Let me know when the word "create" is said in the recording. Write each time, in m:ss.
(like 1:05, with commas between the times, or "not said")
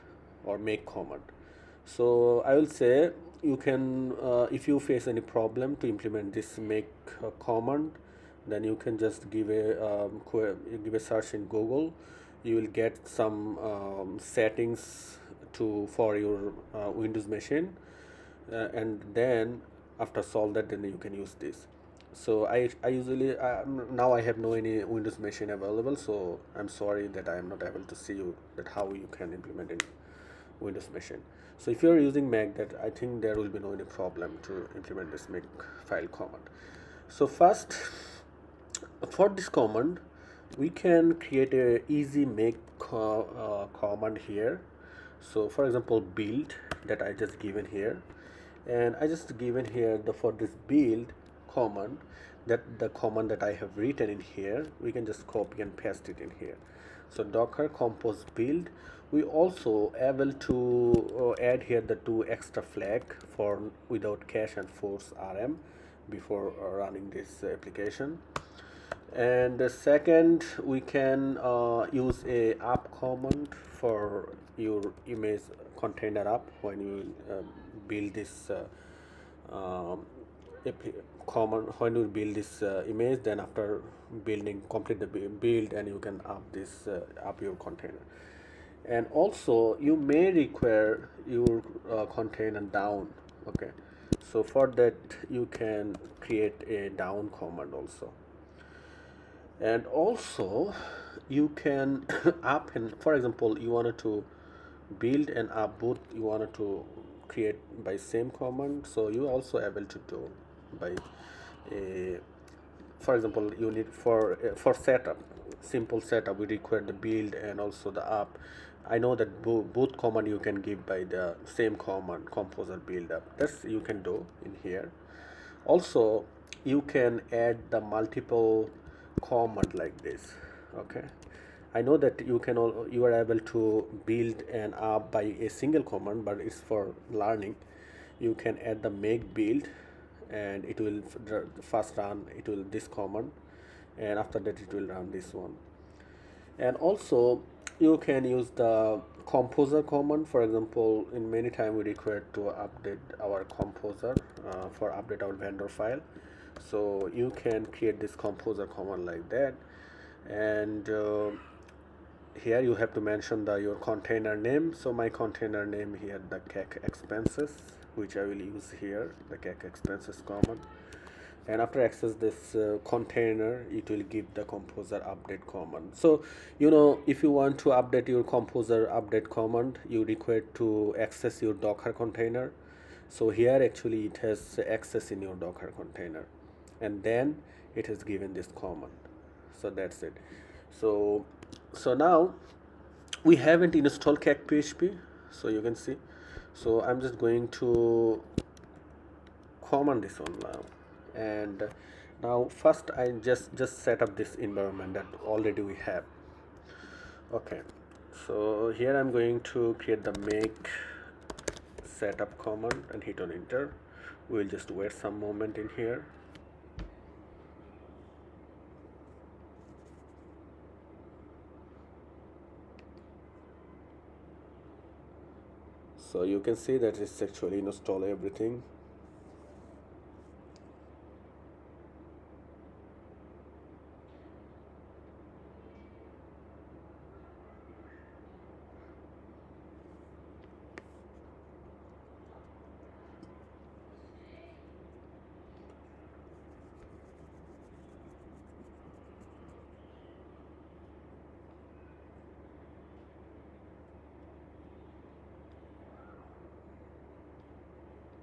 0:41, 1:36, 1:47, 2:37, 3:29.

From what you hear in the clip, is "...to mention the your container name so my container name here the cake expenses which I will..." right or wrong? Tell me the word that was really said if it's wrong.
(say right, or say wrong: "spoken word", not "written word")
right.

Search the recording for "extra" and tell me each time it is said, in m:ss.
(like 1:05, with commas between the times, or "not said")
1:02.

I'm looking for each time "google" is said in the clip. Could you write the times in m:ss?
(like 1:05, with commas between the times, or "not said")
0:11.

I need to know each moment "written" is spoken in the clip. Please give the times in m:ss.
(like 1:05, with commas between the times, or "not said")
0:53.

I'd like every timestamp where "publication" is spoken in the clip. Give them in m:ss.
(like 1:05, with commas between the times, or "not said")
not said.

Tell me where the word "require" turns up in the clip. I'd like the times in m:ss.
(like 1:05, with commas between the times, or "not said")
1:30, 1:56, 2:31, 3:00.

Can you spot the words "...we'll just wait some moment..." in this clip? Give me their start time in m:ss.
3:34.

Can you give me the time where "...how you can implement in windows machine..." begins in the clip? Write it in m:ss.
0:28.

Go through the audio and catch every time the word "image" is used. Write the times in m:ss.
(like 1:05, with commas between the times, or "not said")
1:15, 1:22.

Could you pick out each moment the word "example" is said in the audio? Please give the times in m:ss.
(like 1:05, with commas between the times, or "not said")
0:45, 1:43, 1:53, 2:30.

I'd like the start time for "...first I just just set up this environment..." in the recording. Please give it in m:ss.
3:22.